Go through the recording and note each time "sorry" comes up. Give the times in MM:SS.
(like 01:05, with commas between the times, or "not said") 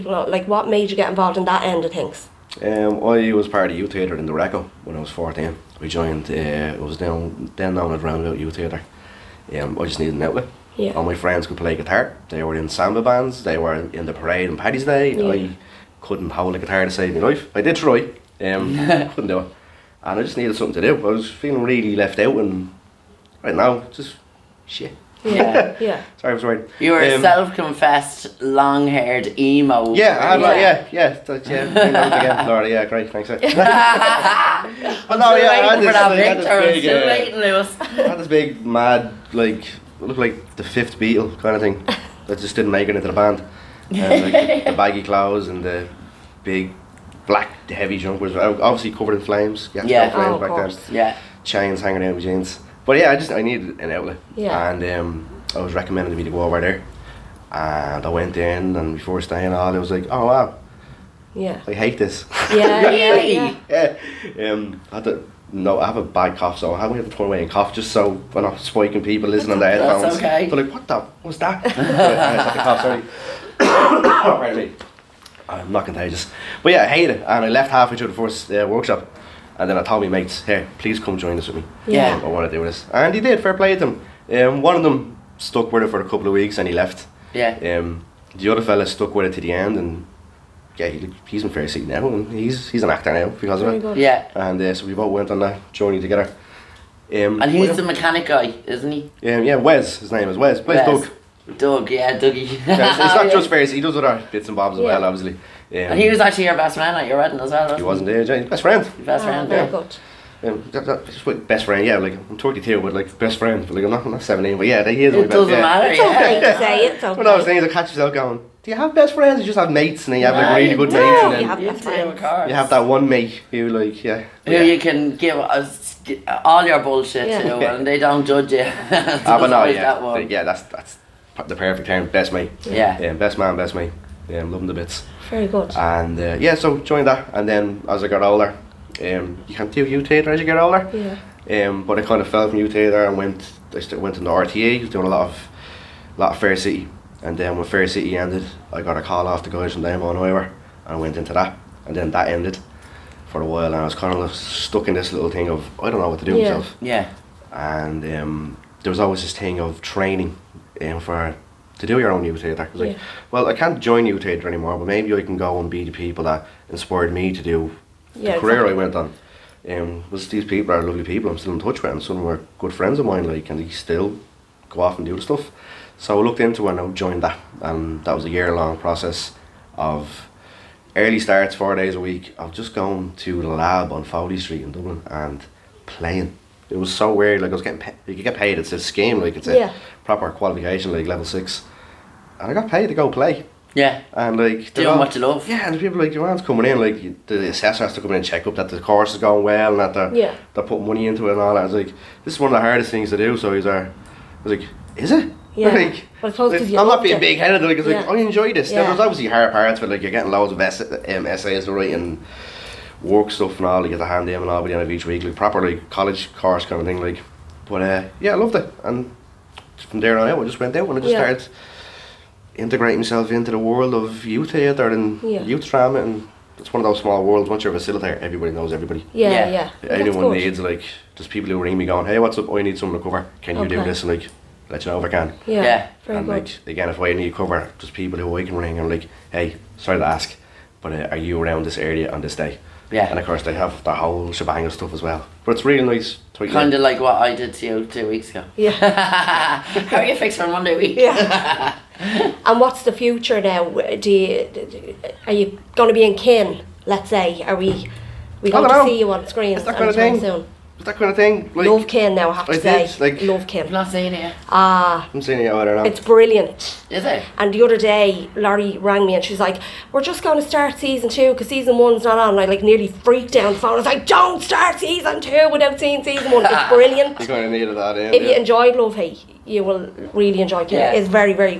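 00:26, 03:59.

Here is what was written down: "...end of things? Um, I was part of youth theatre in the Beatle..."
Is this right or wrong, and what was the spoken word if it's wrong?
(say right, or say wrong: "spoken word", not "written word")
wrong: "Reco", not "Beatle".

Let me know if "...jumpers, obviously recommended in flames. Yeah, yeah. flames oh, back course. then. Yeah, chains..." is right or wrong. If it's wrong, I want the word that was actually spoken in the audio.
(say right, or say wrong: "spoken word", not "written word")
wrong: "covered", not "recommended".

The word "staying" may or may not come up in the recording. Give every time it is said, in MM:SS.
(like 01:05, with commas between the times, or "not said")
00:59.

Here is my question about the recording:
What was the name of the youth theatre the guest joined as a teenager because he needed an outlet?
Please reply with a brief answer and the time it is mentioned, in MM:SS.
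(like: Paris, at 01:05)
Roundabout Youth Theatre, at 00:08.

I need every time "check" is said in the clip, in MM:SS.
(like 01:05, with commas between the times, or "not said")
03:18.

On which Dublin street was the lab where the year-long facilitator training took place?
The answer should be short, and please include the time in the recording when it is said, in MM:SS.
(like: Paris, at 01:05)
Foley Street, at 03:04.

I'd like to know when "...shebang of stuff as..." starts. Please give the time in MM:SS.
04:04.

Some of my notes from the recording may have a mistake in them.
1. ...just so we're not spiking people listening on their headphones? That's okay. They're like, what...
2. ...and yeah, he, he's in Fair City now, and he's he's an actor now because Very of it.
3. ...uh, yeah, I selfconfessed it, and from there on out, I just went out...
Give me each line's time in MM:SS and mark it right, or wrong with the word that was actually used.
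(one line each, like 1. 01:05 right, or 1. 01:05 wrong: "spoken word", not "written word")
1. 01:07 right
2. 01:29 right
3. 03:37 wrong: "loved", not "selfconfessed".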